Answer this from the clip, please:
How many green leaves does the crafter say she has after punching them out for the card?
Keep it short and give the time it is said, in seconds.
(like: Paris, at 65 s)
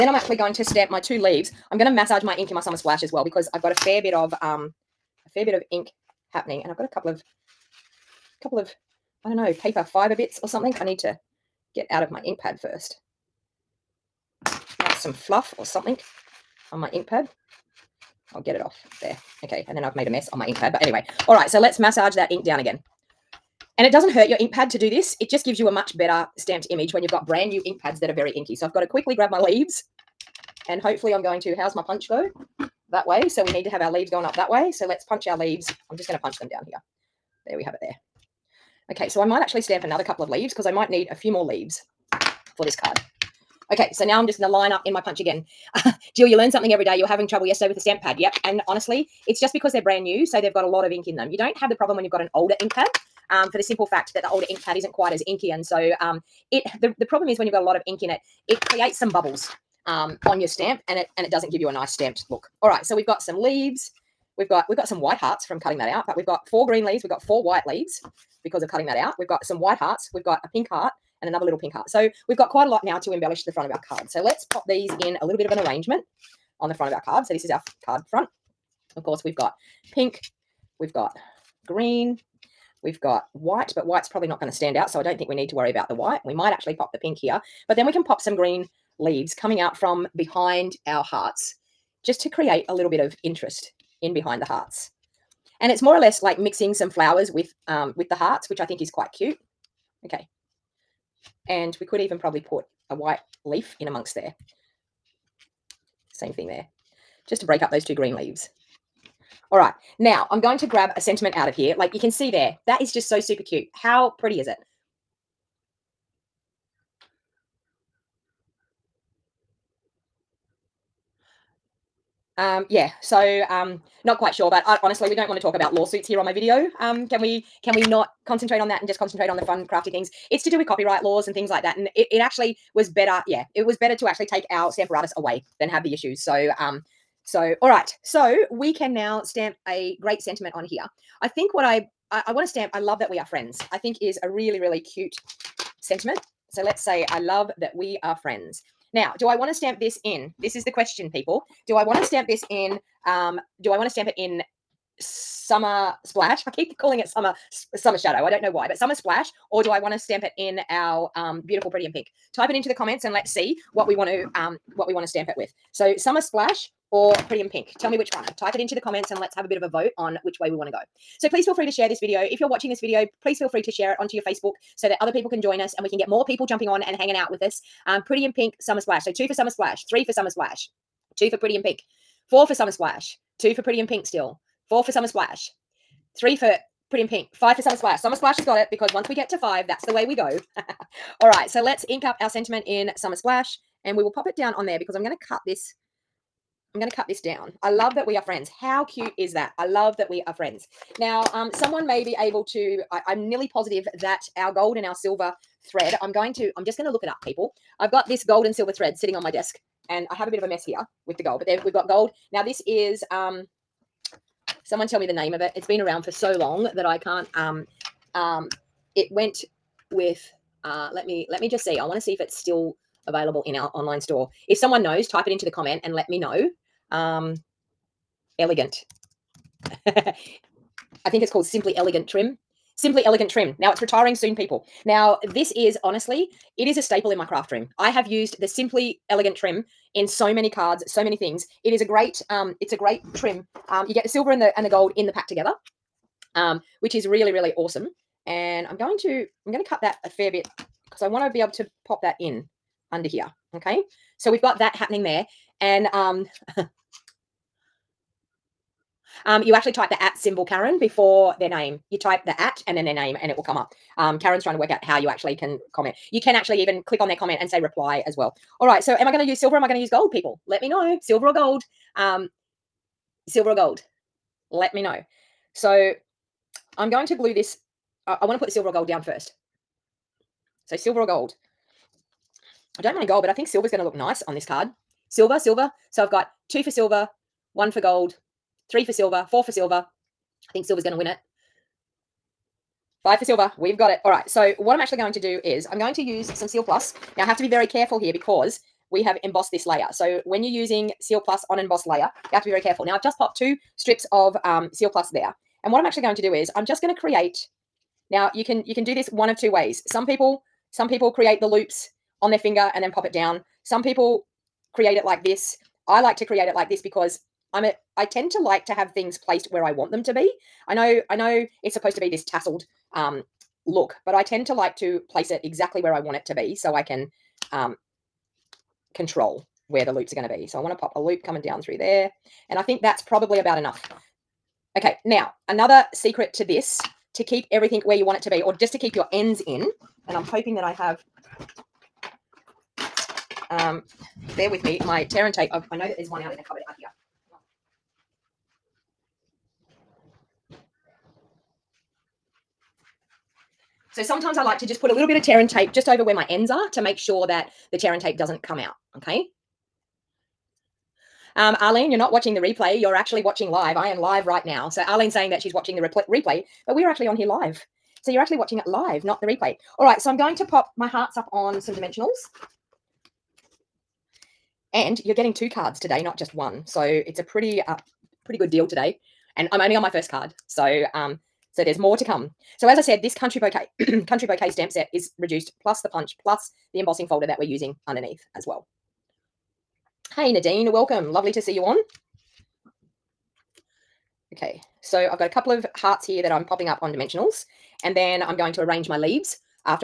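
4, at 66 s.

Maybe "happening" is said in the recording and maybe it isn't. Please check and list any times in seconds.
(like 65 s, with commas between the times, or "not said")
6 s, 254 s.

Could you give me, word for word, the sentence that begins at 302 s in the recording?
Now, I've just popped two strips of um, Seal Plus there.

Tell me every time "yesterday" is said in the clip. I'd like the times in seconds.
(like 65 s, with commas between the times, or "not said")
47 s.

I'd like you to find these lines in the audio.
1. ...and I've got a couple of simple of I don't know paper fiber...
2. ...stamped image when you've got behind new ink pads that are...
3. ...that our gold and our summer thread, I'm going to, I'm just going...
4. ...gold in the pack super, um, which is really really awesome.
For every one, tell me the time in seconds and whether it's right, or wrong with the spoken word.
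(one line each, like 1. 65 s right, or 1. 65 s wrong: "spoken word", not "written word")
1. 6 s wrong: "couple", not "simple"
2. 26 s wrong: "brand", not "behind"
3. 203 s wrong: "silver", not "summer"
4. 244 s wrong: "together", not "super".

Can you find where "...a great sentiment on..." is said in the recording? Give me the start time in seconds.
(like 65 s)
139 s.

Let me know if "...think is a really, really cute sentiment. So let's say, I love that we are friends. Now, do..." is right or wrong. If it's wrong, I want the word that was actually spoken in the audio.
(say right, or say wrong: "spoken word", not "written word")
right.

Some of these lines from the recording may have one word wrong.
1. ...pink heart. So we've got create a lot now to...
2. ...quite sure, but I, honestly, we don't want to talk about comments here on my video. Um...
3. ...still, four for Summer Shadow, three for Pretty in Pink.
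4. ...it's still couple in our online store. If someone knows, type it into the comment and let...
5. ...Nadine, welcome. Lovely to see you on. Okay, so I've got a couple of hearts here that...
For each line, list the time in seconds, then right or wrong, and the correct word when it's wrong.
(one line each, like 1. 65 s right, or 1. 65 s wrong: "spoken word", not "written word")
1. 71 s wrong: "quite", not "create"
2. 124 s wrong: "lawsuits", not "comments"
3. 184 s wrong: "Splash", not "Shadow"
4. 222 s wrong: "available", not "couple"
5. 390 s right.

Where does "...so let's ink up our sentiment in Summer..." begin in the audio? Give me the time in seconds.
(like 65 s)
191 s.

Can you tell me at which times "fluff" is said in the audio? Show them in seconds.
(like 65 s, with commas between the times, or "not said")
15 s.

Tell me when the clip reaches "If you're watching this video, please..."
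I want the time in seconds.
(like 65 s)
172 s.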